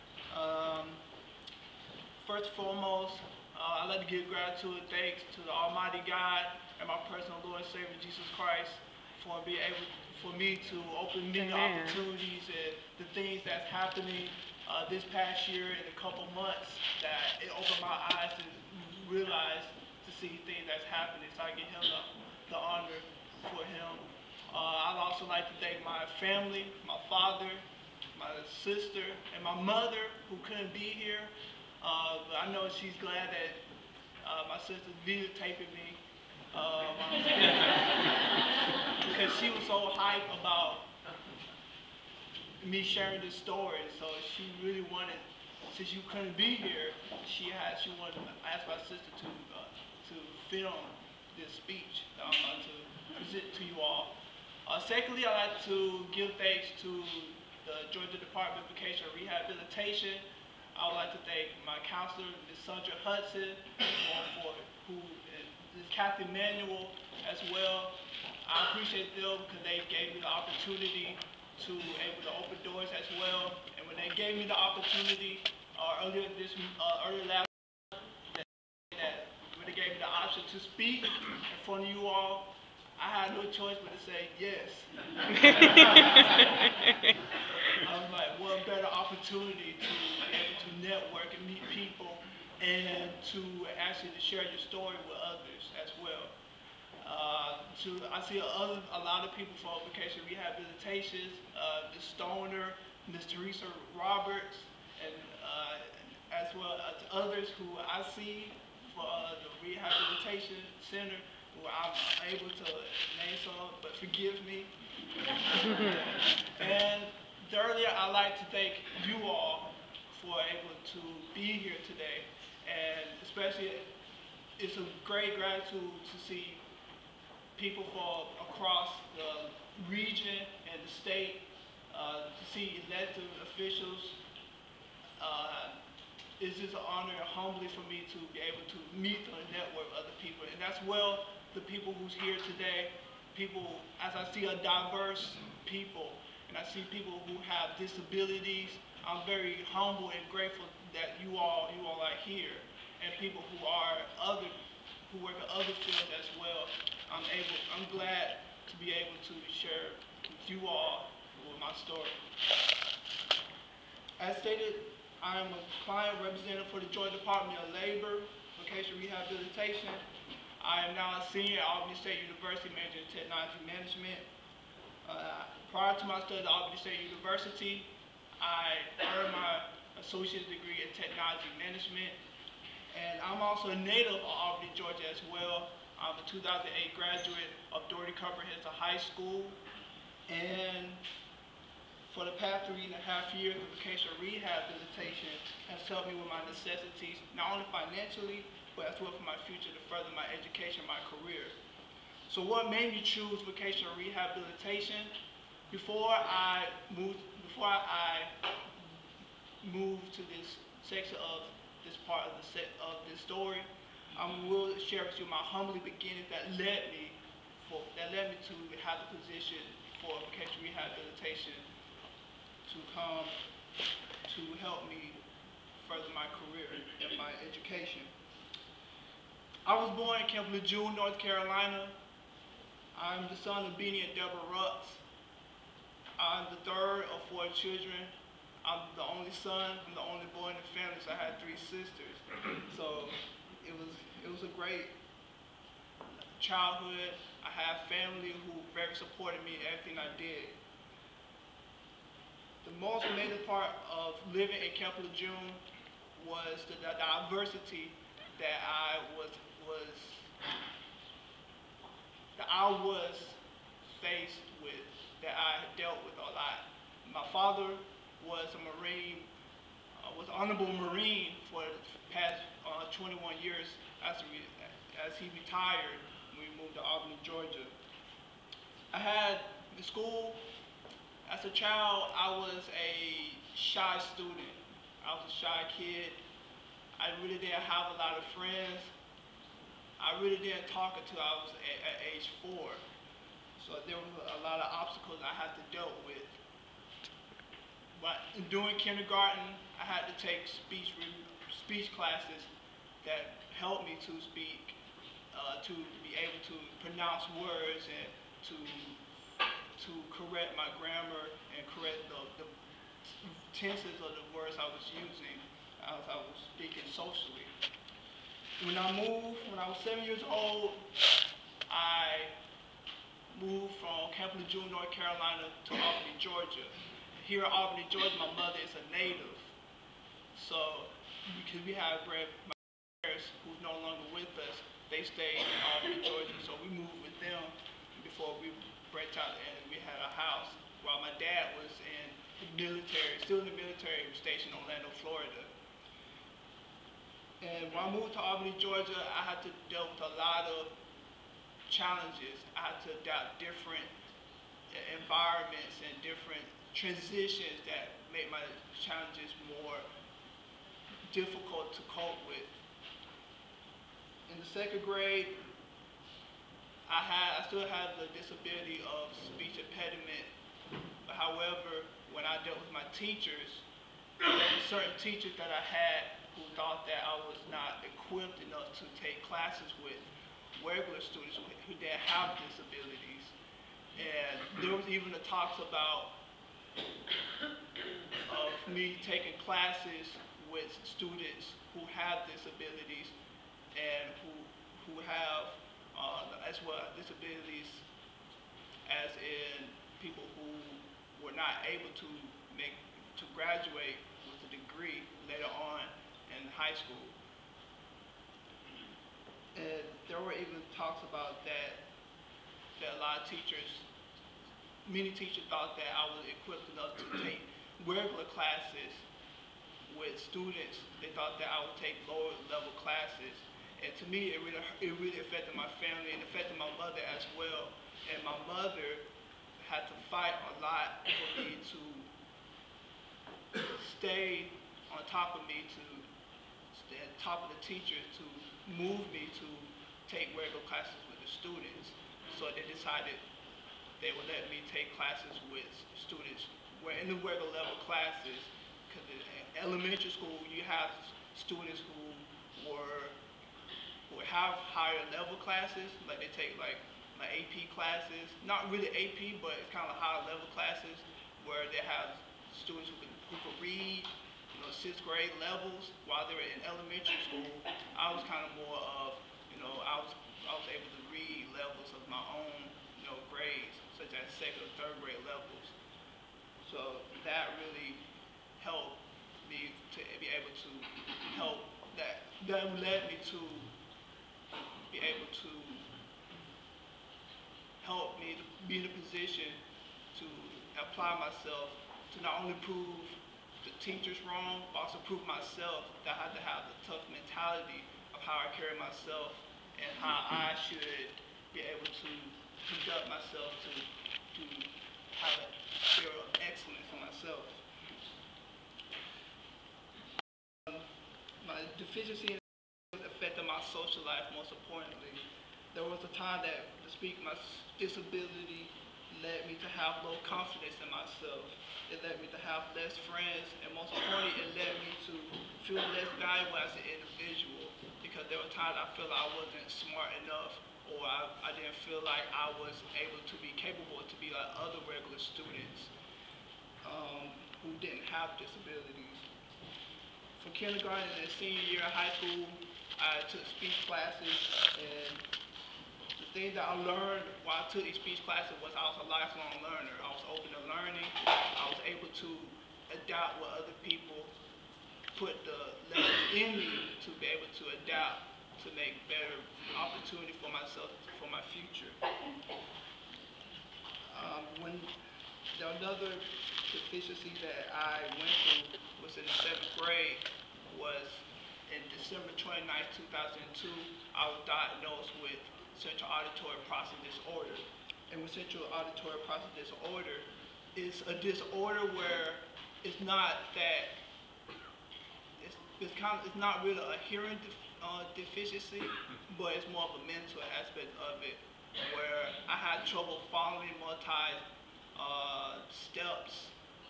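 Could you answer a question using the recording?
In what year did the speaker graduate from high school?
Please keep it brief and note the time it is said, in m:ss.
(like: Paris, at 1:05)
2008, at 3:06.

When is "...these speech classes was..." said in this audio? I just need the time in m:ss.
9:07.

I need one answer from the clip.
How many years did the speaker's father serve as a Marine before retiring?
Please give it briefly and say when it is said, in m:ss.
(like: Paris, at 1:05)
21, at 4:32.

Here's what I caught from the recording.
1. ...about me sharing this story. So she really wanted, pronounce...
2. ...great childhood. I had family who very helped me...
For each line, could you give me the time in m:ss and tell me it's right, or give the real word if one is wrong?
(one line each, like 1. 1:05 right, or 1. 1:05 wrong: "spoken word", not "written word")
1. 0:40 wrong: "since", not "pronounce"
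2. 4:04 wrong: "supported", not "helped".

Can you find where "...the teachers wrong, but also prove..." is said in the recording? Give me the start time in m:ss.
8:13.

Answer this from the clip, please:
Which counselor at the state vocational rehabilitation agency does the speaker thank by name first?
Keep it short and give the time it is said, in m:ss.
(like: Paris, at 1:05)
Sandra Hudson, at 1:02.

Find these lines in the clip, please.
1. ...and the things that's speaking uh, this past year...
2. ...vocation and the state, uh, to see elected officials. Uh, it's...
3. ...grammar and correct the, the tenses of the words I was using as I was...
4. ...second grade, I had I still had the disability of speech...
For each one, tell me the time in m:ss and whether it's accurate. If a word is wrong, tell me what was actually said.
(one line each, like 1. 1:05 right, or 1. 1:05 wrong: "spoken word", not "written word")
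1. 0:12 wrong: "happening", not "speaking"
2. 2:09 wrong: "region", not "vocation"
3. 5:10 right
4. 6:04 right.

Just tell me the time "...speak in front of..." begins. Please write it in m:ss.
1:20.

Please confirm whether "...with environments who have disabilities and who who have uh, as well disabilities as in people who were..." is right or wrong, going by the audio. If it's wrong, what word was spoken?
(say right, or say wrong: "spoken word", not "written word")
wrong: "students", not "environments".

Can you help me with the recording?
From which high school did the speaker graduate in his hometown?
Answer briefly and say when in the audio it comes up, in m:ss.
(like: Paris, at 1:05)
Dougherty Comprehensive High School, at 3:07.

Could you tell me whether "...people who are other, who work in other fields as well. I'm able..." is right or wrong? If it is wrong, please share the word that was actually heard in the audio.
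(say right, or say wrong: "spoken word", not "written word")
right.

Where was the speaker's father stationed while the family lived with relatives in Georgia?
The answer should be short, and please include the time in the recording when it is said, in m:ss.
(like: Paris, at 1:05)
Orlando, Florida, at 5:44.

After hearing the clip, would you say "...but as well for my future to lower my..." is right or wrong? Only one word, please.
wrong.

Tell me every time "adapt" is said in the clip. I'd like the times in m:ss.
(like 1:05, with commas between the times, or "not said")
5:53, 9:12, 9:17.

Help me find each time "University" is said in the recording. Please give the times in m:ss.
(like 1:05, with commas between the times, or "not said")
2:52, 2:57.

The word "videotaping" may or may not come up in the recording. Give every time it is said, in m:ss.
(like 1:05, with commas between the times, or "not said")
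0:35.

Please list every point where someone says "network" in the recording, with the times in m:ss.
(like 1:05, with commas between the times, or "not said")
1:30, 2:19.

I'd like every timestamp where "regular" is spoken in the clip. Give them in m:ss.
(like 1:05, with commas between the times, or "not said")
6:20, 6:57, 7:20, 7:27, 8:54.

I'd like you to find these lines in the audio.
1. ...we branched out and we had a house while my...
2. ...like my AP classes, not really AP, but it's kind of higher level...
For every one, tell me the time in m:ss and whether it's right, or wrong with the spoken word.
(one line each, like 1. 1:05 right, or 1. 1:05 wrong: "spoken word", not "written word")
1. 5:38 right
2. 7:36 right.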